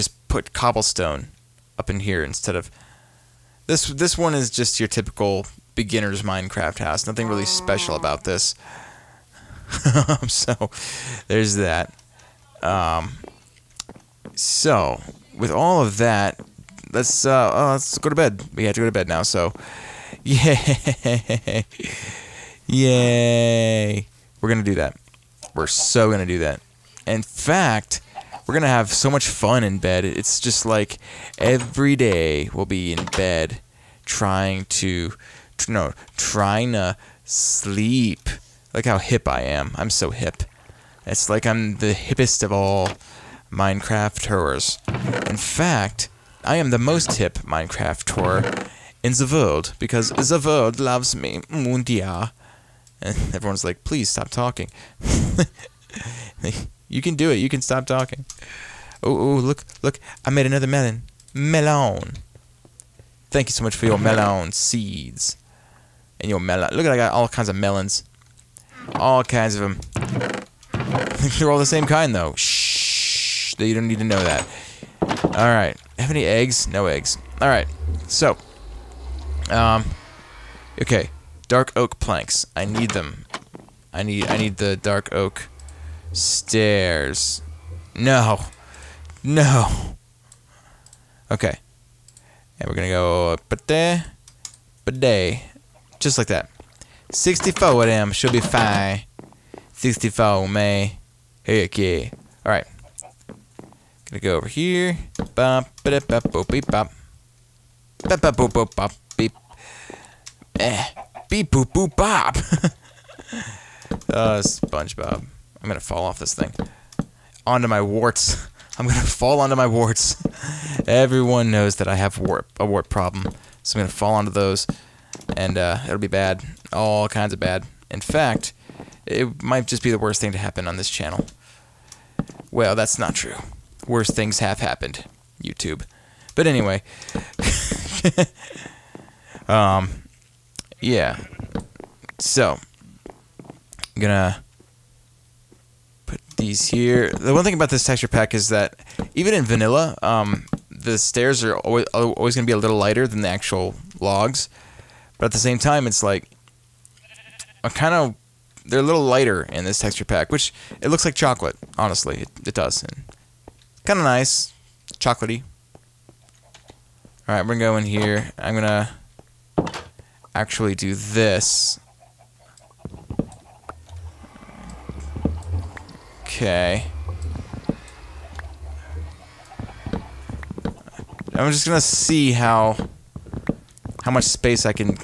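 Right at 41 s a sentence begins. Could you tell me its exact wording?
It's like I'm the hippest of all Minecrafters.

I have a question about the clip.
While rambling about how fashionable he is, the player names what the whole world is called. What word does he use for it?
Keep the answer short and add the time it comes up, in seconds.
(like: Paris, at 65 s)
Mundia, at 51 s.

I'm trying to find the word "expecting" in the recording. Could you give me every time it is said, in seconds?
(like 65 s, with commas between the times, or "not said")
not said.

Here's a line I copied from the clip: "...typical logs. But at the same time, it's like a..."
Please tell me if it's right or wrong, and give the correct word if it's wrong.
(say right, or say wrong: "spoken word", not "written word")
wrong: "actual", not "typical".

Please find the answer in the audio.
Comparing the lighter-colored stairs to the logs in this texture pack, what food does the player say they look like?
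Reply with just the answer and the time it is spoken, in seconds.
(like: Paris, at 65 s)
chocolate, at 161 s.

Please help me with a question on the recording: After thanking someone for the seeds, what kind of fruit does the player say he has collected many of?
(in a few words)
melons.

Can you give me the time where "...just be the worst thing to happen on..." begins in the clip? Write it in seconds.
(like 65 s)
129 s.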